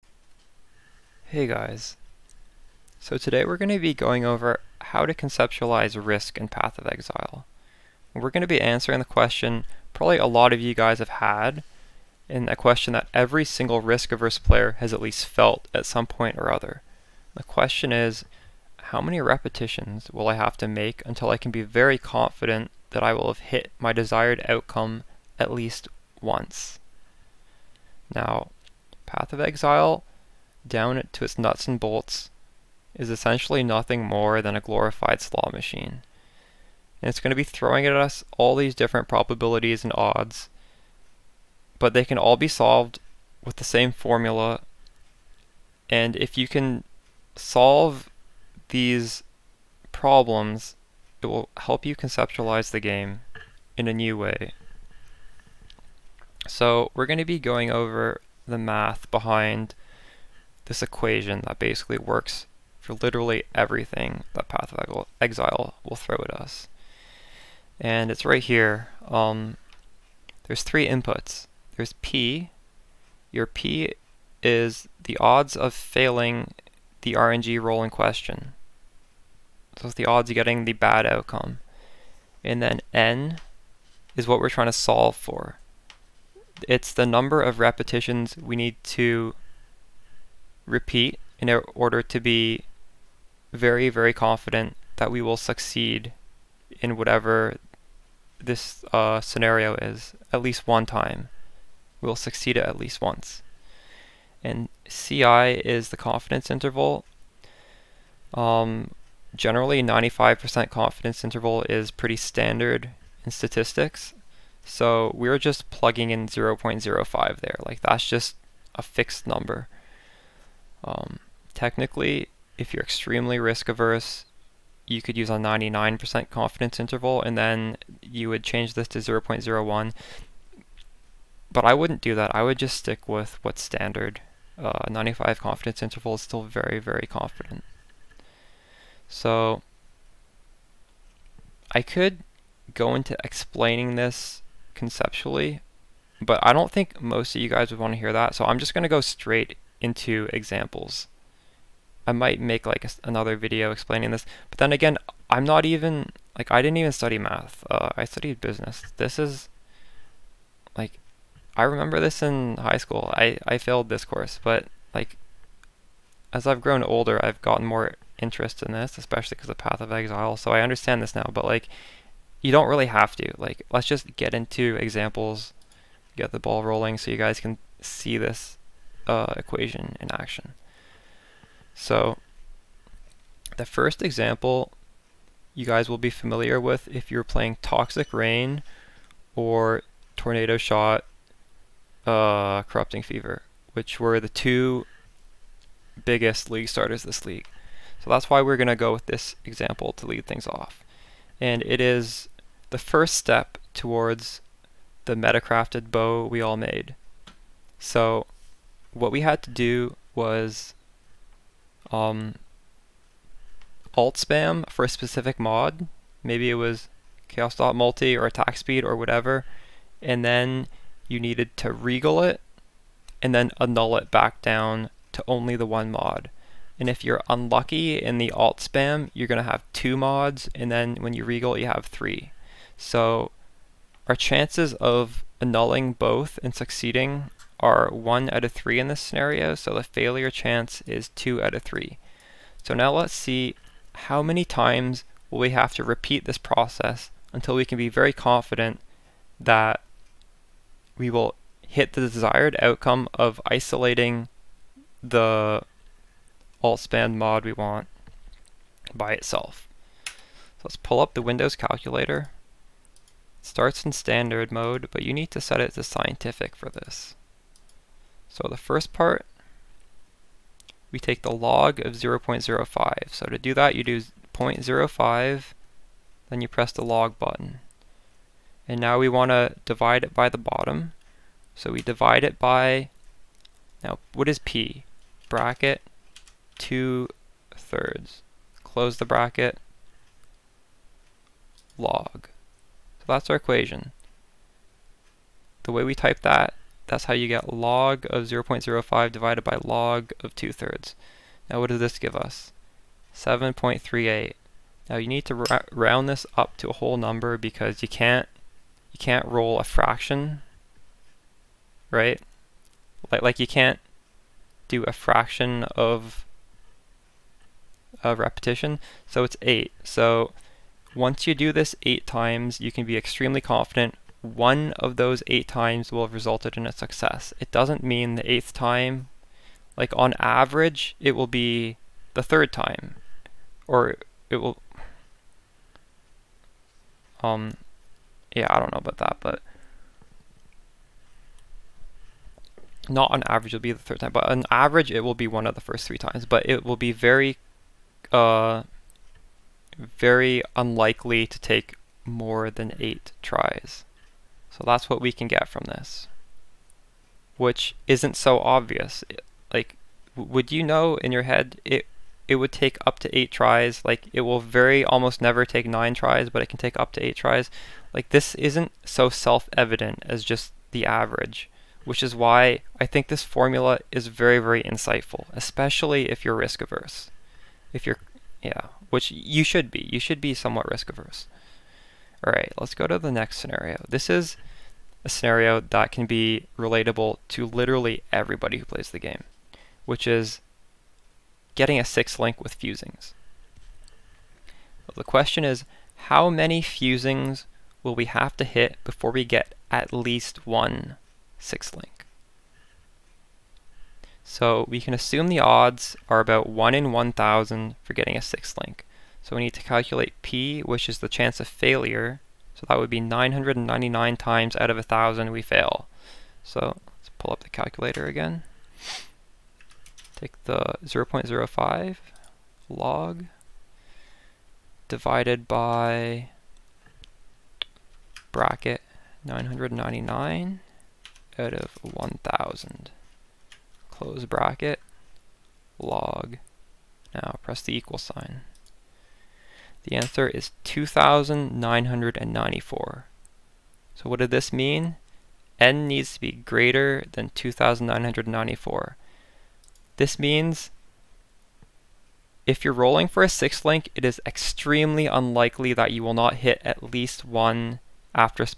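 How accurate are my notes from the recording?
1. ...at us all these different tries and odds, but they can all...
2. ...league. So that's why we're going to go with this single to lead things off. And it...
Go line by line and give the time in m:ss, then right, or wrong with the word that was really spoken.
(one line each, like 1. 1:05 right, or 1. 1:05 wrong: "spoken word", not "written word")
1. 0:37 wrong: "probabilities", not "tries"
2. 3:17 wrong: "example", not "single".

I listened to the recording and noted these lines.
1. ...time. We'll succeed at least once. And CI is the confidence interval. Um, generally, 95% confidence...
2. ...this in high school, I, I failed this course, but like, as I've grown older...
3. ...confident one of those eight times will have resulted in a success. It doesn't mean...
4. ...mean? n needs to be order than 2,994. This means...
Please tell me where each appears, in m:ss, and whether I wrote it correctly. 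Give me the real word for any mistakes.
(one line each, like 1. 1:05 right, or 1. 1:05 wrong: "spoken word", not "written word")
1. 1:40 right
2. 2:41 right
3. 5:23 right
4. 7:24 wrong: "greater", not "order".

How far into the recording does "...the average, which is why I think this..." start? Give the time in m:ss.
6:10.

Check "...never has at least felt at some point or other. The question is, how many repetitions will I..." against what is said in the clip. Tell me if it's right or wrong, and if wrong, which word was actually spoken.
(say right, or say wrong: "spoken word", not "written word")
wrong: "player", not "never".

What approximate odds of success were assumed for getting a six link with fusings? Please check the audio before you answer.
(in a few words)
1 in 1,000.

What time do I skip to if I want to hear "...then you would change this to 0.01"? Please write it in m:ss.
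2:07.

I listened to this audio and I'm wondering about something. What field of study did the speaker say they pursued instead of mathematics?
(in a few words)
Business.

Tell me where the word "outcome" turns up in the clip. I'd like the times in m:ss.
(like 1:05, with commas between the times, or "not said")
0:24, 1:21, 4:12.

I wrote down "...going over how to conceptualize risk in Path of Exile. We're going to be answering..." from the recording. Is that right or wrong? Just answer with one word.
right.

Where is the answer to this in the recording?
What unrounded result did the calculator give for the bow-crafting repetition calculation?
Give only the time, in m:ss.
5:03.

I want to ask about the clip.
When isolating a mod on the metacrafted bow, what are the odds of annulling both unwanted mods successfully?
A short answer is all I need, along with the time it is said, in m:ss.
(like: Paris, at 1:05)
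1 out of 3, at 3:57.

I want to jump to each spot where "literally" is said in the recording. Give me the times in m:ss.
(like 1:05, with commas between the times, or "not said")
1:02, 6:27.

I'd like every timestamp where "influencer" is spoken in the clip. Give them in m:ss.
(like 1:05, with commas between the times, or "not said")
not said.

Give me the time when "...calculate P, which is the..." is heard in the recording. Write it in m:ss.
6:49.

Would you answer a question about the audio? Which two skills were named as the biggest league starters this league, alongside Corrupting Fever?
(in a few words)
Toxic Rain or Tornado Shot.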